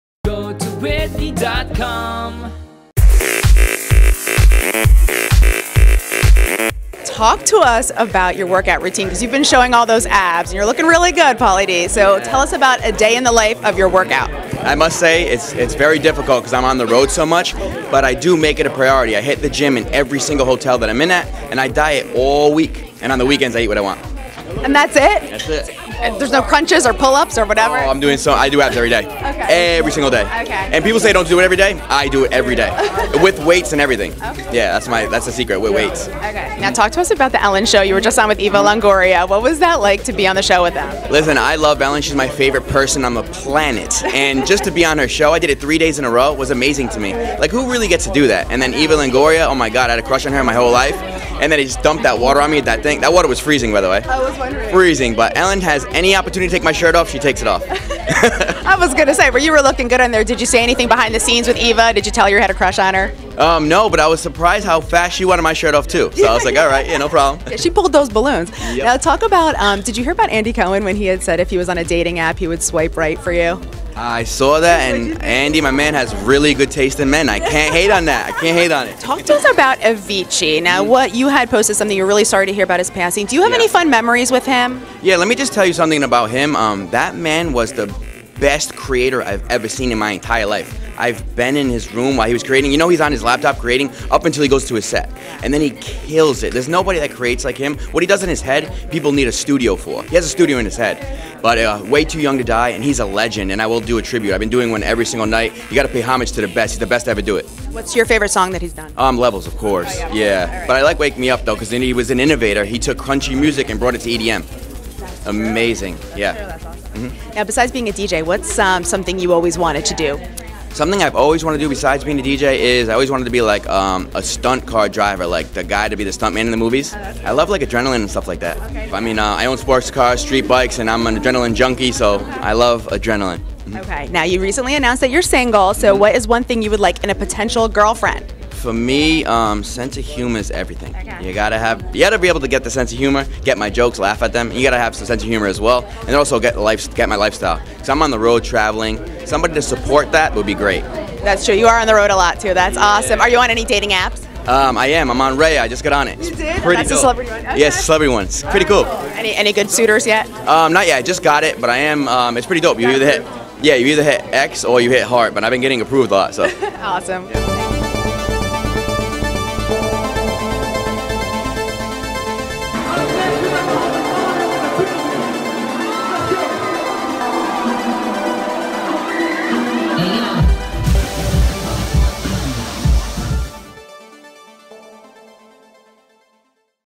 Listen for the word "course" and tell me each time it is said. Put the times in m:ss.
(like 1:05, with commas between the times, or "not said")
1:49.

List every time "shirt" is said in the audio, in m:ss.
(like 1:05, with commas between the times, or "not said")
0:56, 1:05.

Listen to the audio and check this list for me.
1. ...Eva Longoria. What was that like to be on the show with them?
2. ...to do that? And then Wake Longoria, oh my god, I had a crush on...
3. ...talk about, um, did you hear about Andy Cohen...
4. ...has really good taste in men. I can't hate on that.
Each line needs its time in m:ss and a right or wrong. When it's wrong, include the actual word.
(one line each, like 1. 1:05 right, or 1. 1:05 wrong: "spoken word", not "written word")
1. 0:38 right
2. 0:48 wrong: "Eva", not "Wake"
3. 1:08 right
4. 1:15 right.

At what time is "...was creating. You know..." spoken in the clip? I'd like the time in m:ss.
1:32.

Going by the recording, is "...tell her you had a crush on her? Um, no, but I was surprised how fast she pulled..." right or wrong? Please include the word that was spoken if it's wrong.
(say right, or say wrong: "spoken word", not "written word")
wrong: "wanted", not "pulled".